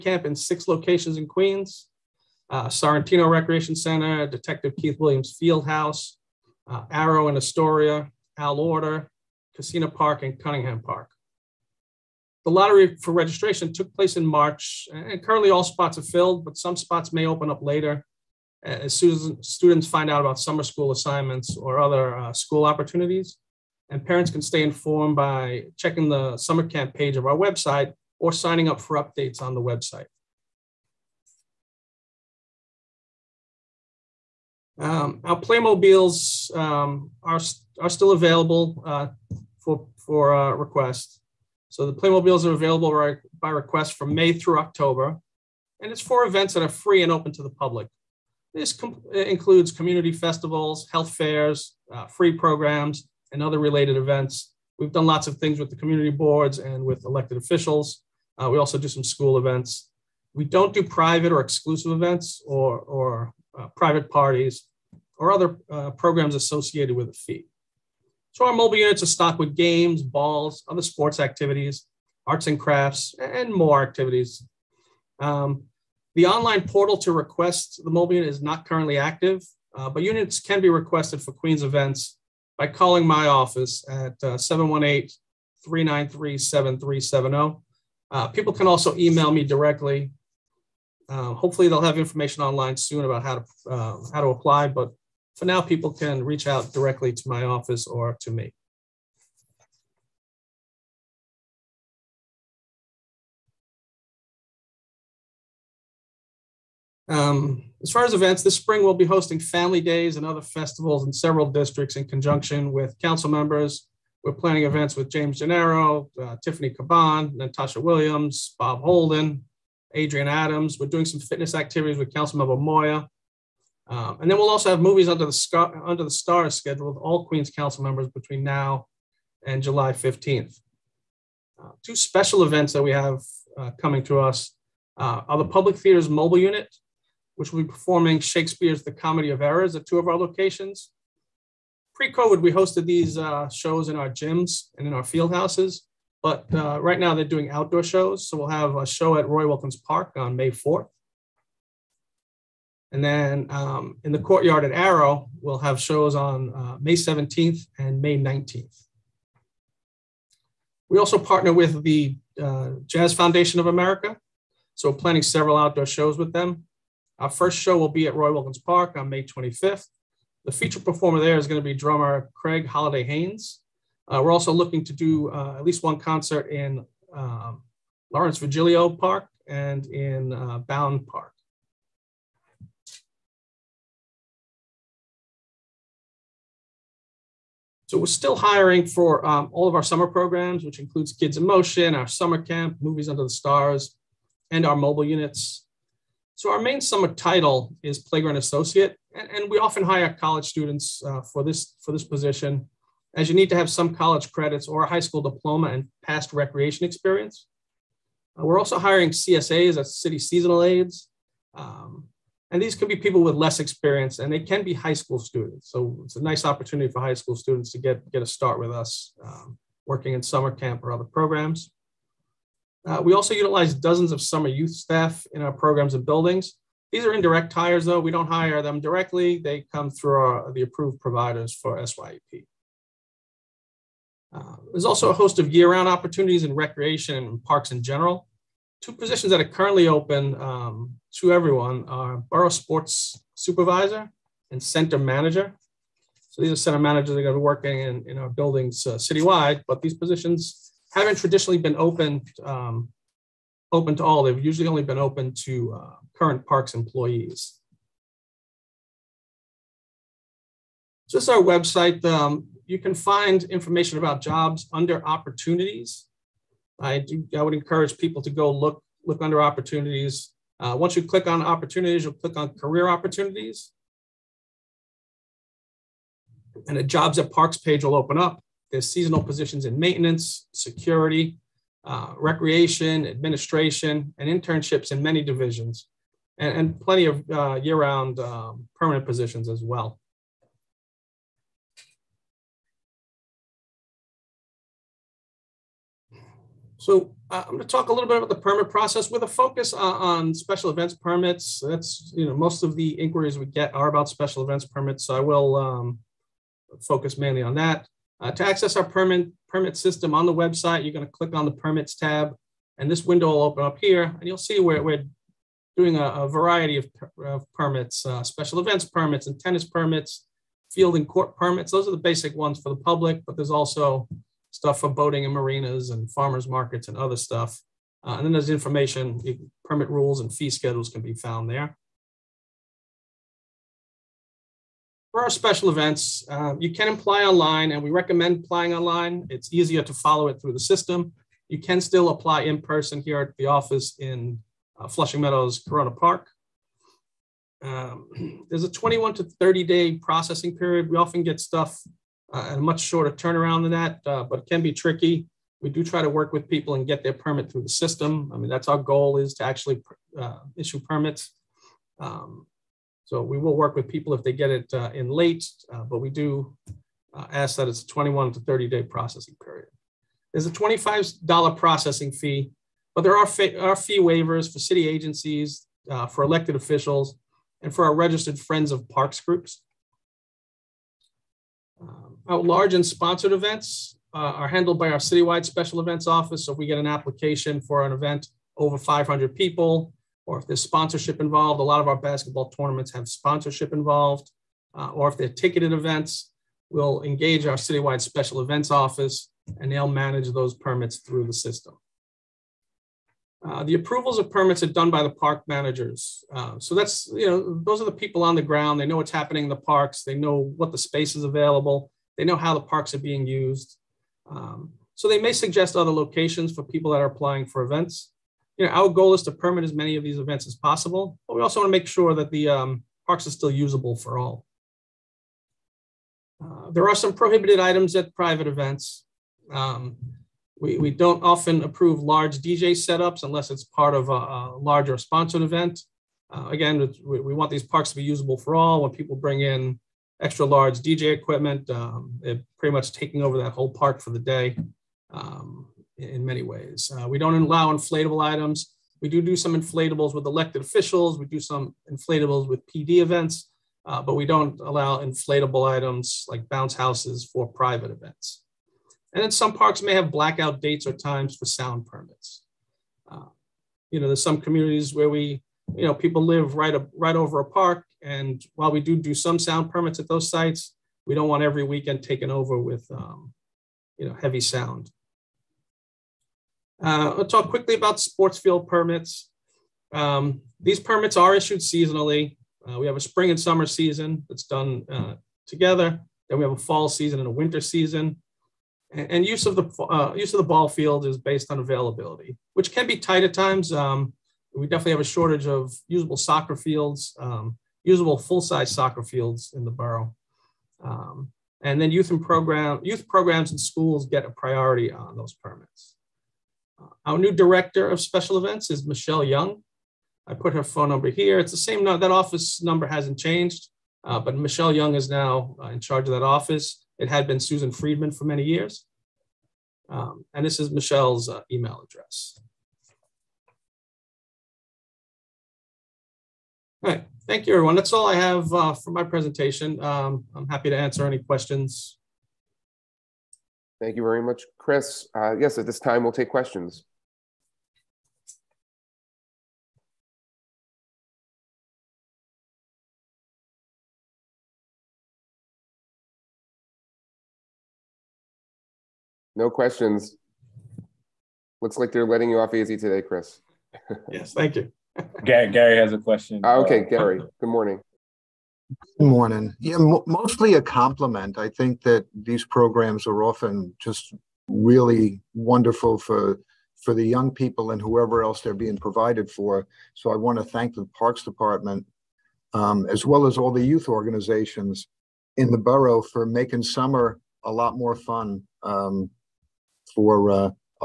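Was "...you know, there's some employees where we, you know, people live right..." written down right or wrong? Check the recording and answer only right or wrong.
wrong.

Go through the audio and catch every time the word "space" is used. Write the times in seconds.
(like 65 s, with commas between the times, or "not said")
410 s.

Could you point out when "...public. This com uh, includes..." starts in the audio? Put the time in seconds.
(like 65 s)
47 s.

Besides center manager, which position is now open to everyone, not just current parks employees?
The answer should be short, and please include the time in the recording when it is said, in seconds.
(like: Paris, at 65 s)
Borough sports supervisor, at 242 s.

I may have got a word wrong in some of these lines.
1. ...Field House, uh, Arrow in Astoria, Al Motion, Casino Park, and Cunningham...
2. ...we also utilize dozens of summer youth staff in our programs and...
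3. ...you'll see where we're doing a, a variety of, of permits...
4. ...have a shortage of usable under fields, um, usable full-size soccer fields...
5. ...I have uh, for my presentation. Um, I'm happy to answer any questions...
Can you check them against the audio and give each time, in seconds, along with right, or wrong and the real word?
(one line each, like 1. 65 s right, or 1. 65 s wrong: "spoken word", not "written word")
1. 5 s wrong: "Oerter", not "Motion"
2. 223 s right
3. 314 s right
4. 494 s wrong: "soccer", not "under"
5. 528 s right.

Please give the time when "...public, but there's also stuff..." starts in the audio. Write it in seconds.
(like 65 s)
322 s.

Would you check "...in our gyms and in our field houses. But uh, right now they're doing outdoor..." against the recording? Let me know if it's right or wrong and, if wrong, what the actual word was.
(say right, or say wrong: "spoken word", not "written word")
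right.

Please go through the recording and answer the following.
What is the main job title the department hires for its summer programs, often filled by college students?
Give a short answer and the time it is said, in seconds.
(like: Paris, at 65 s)
Playground Associate, at 197 s.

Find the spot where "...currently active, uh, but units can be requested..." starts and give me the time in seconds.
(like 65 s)
78 s.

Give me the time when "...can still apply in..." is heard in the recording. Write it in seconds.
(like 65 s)
341 s.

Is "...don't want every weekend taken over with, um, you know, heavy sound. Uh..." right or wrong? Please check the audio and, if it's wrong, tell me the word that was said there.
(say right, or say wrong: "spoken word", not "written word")
right.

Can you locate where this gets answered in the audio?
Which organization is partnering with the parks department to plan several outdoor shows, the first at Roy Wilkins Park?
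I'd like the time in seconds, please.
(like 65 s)
162 s.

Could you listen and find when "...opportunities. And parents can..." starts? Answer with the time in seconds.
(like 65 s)
22 s.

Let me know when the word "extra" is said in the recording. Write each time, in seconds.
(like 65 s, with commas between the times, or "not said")
440 s.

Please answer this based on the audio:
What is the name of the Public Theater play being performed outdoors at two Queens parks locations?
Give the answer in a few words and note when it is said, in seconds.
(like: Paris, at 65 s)
The Comedy of Errors, at 138 s.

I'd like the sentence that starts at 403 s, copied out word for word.
Uh, the approvals of permits are done by the park managers.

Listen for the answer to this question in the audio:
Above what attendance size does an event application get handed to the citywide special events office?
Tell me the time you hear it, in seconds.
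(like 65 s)
388 s.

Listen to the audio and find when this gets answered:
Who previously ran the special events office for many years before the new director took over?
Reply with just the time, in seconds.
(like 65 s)
517 s.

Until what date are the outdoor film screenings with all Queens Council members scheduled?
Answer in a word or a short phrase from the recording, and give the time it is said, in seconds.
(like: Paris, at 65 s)
July 15th, at 129 s.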